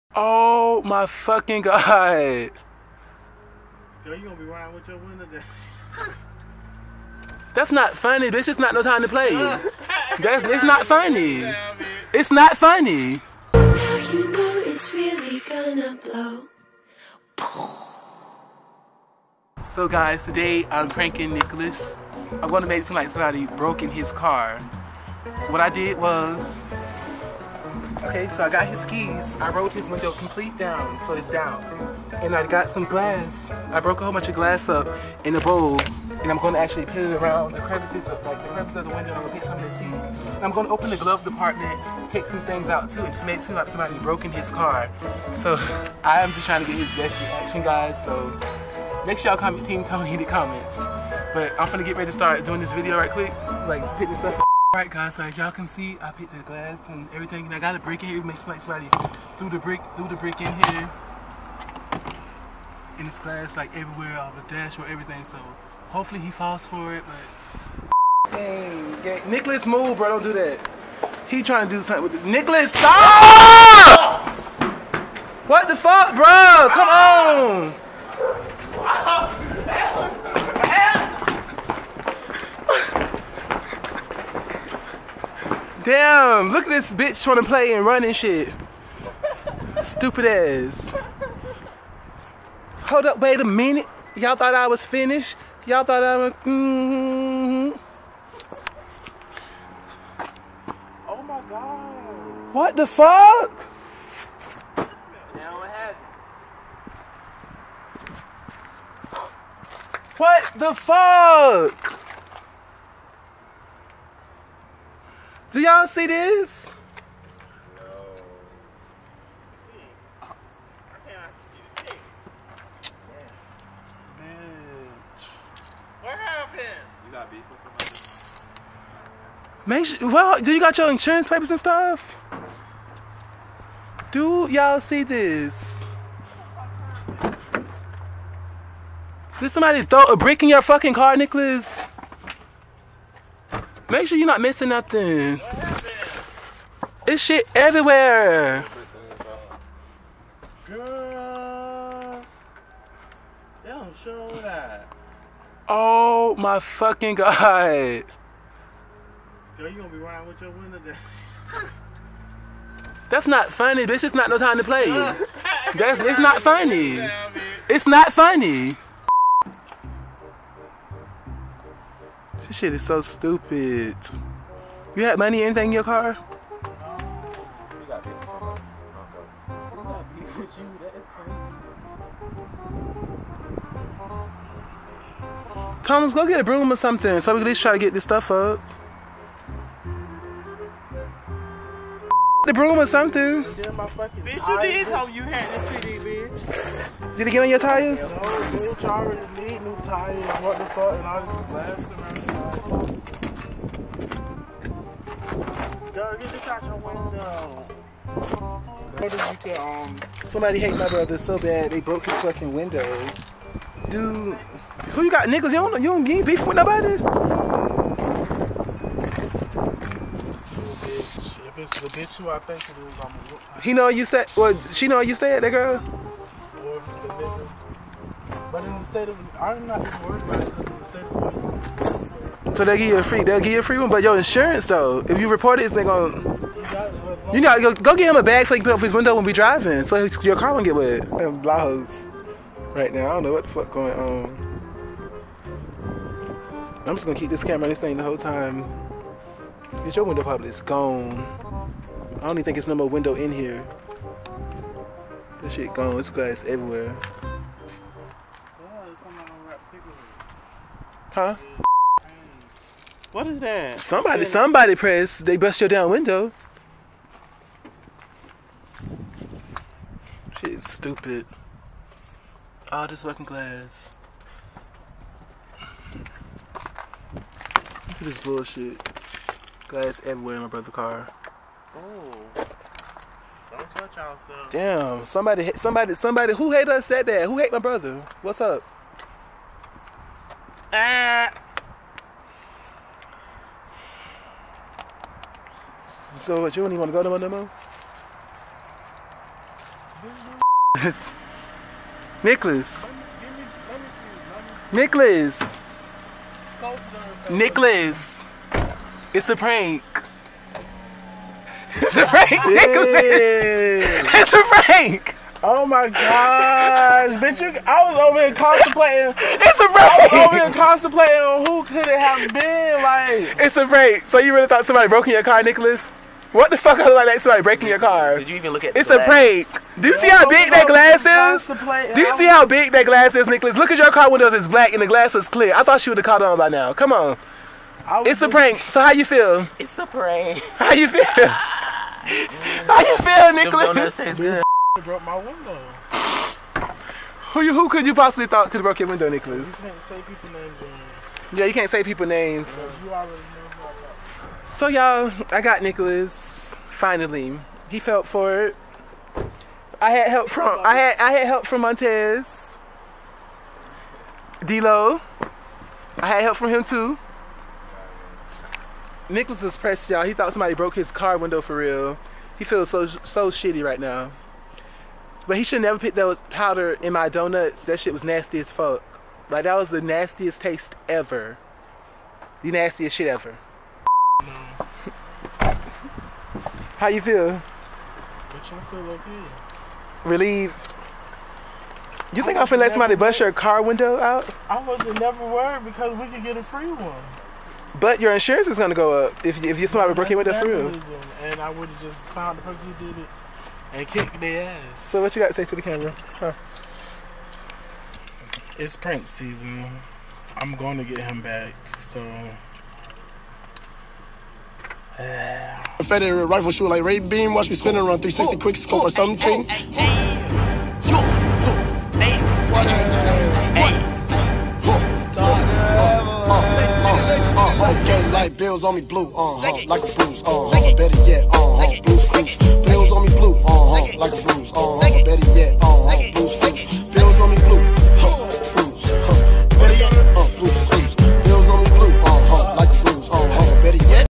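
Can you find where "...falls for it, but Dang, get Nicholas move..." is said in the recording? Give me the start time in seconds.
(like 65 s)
66 s.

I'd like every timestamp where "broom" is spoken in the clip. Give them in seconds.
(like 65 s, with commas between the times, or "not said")
186 s, 192 s.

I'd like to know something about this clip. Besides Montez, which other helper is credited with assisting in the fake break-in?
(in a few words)
D-Lo.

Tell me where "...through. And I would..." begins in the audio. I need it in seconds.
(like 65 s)
400 s.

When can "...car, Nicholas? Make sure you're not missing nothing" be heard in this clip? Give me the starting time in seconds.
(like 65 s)
140 s.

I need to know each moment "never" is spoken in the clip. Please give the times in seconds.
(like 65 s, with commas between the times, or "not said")
375 s, 394 s.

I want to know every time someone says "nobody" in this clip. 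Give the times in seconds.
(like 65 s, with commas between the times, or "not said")
216 s.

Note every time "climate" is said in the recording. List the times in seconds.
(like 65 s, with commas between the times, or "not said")
not said.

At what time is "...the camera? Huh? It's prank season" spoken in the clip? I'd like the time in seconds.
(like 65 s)
405 s.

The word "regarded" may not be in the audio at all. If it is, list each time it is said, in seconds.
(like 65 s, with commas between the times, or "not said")
not said.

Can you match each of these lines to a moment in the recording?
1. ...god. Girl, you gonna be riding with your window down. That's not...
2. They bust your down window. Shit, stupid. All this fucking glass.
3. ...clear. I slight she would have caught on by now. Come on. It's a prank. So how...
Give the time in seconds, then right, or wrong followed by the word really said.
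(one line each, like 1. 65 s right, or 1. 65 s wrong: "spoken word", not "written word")
1. 157 s right
2. 265 s right
3. 335 s wrong: "thought", not "slight".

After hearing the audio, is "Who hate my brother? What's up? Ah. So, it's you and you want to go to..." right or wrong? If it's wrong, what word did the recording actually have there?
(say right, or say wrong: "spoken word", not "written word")
right.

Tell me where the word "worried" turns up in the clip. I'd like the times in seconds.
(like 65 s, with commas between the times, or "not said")
230 s, 395 s.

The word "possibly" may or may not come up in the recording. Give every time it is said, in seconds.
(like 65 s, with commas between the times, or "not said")
347 s.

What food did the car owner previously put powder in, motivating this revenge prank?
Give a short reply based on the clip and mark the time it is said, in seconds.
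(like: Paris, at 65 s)
Donuts, at 377 s.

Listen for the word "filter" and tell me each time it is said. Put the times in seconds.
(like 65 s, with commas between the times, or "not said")
not said.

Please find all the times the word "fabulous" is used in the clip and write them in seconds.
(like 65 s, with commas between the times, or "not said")
not said.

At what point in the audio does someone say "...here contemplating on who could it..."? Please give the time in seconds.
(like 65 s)
320 s.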